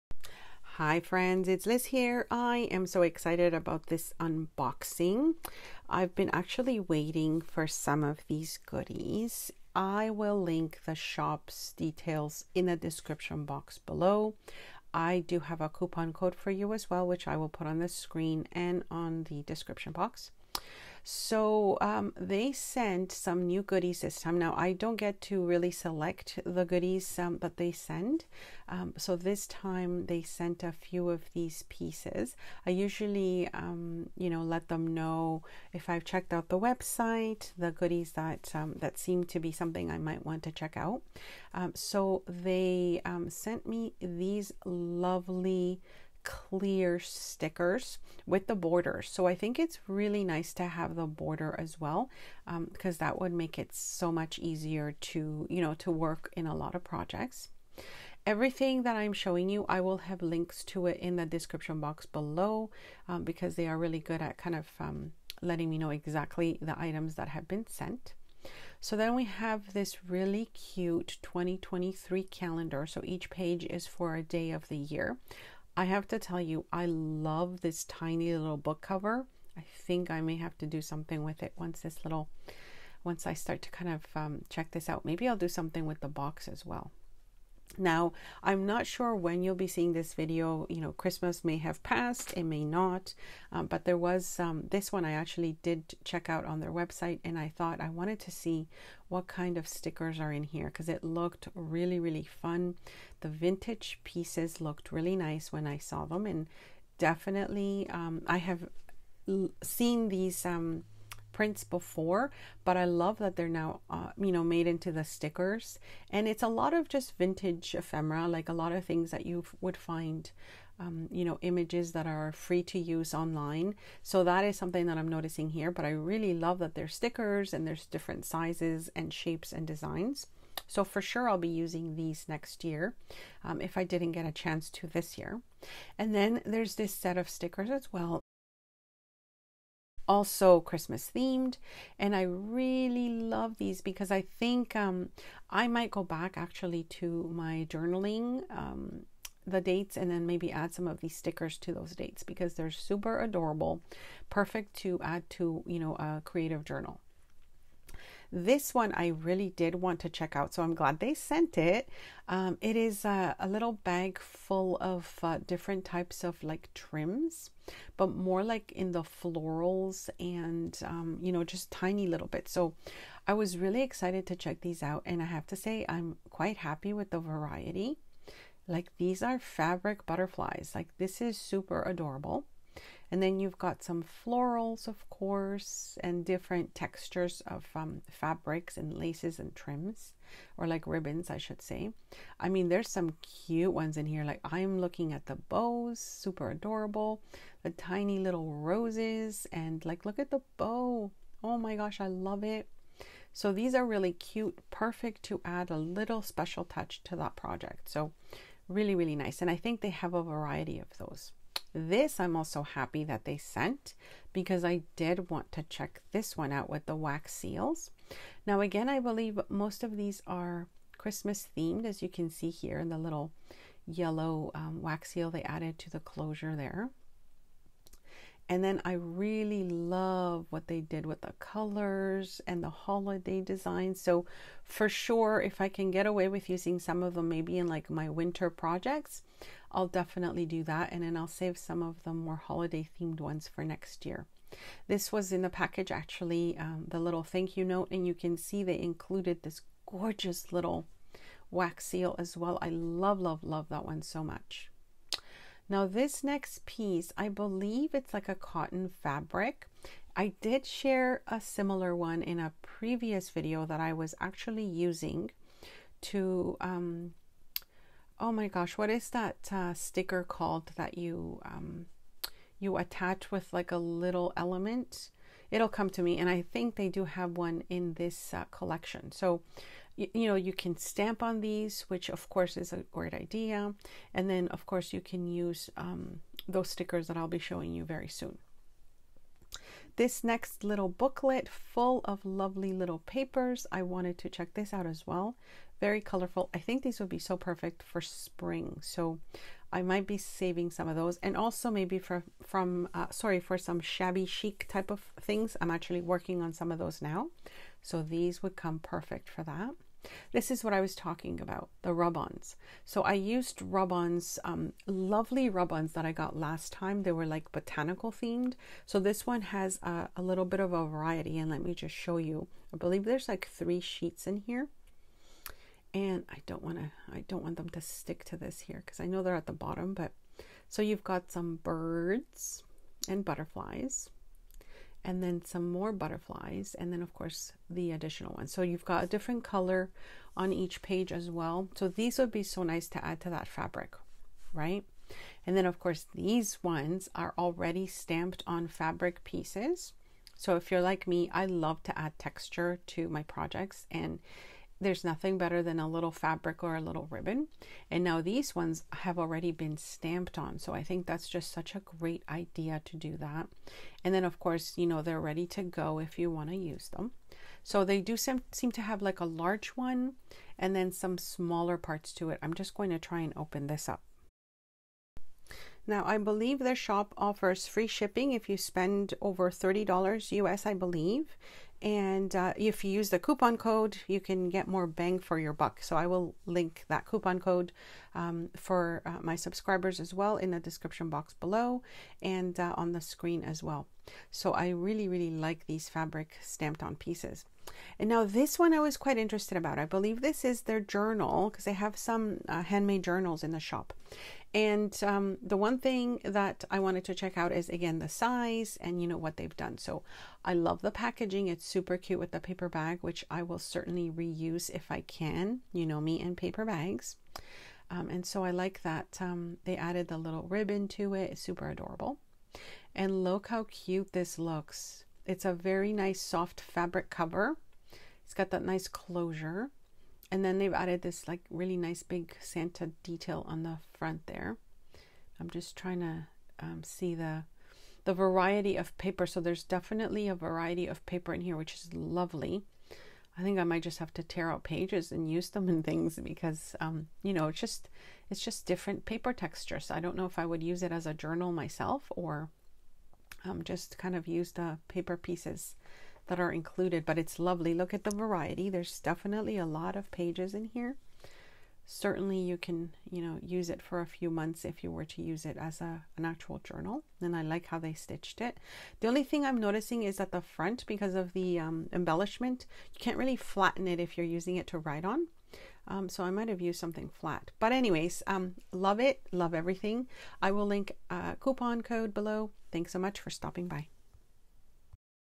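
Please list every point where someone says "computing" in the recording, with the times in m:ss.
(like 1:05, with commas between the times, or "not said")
not said.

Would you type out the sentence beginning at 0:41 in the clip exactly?
Um, so they sent me these lovely clear stickers with the border.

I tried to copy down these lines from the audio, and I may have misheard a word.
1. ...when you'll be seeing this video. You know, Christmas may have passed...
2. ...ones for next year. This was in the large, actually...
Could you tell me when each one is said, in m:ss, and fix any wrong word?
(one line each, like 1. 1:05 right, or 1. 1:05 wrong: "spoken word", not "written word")
1. 1:29 right
2. 4:03 wrong: "package", not "large".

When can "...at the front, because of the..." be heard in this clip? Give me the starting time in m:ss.
7:50.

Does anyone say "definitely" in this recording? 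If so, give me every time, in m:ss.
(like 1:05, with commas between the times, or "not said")
1:46, 3:59, 7:19, 7:38.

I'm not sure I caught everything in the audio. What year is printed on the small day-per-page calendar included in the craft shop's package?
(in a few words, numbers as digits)
2023.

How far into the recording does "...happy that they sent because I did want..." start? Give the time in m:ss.
3:32.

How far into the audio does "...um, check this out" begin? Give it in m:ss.
1:24.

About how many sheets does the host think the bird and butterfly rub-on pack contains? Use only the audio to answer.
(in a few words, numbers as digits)
3.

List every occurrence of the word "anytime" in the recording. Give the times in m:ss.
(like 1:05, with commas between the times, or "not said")
not said.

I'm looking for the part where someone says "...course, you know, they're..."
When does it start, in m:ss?
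6:04.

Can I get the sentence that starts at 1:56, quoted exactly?
And it's a lot of just vintage ephemera, like a lot of things that you would find.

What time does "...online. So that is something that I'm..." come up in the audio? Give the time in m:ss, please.
2:03.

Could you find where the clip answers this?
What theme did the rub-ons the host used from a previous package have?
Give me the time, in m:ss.
5:17.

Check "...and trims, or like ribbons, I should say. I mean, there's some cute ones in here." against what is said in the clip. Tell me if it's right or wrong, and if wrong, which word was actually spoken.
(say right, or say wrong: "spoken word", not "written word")
right.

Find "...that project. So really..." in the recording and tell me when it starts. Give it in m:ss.
3:27.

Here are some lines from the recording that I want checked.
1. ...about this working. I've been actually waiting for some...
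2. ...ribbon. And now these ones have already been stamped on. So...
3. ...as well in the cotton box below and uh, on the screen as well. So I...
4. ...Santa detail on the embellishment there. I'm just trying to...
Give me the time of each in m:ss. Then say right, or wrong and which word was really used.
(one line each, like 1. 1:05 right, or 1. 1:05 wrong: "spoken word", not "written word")
1. 0:03 wrong: "unboxing", not "working"
2. 5:57 right
3. 6:29 wrong: "description", not "cotton"
4. 7:12 wrong: "front", not "embellishment".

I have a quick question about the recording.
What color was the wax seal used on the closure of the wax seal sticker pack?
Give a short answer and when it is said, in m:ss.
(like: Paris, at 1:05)
yellow, at 3:43.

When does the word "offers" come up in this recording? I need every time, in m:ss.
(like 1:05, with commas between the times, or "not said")
6:17.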